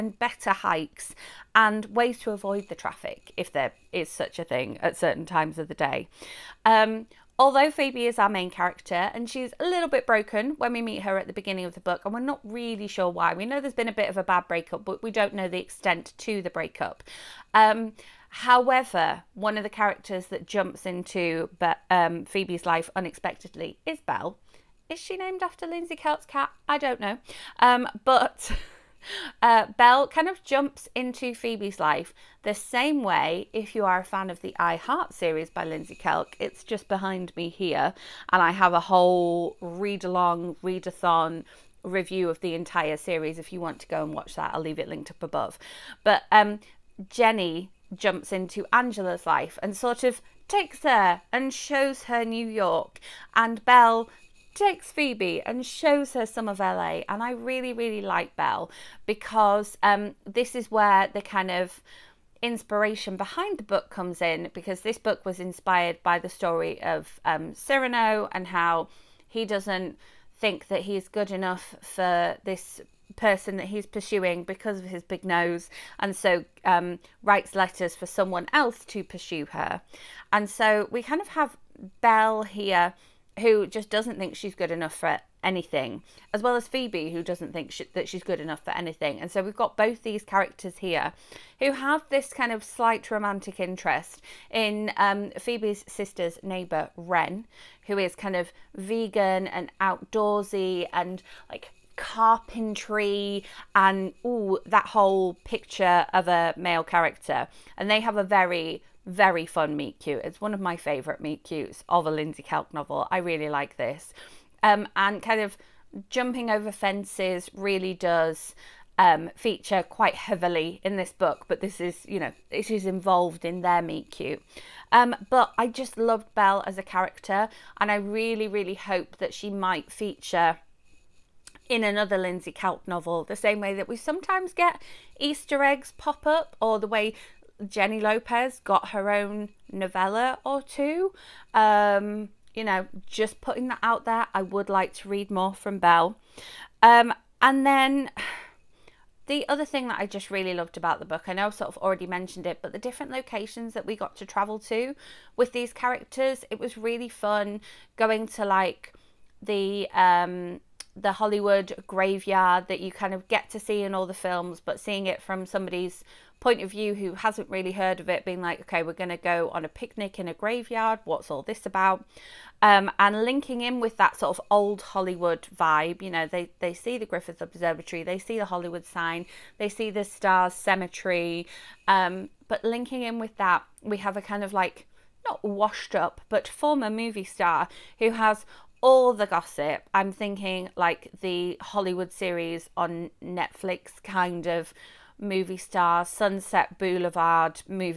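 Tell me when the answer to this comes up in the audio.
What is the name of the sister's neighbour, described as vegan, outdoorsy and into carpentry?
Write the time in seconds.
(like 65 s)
96 s.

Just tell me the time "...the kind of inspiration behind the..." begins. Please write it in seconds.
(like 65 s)
61 s.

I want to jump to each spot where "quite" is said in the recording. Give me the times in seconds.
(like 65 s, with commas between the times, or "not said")
119 s.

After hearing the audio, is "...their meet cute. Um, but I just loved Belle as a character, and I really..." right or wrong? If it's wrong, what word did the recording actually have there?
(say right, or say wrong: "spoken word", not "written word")
right.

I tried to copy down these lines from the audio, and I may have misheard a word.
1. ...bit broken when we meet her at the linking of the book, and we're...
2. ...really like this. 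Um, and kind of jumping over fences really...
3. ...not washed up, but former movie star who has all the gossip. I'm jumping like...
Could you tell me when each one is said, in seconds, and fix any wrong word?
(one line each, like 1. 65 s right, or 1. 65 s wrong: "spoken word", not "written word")
1. 9 s wrong: "beginning", not "linking"
2. 113 s right
3. 185 s wrong: "thinking", not "jumping".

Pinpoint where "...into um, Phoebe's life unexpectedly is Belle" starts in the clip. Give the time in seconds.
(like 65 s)
20 s.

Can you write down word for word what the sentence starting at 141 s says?
Um, you know, just putting that out there.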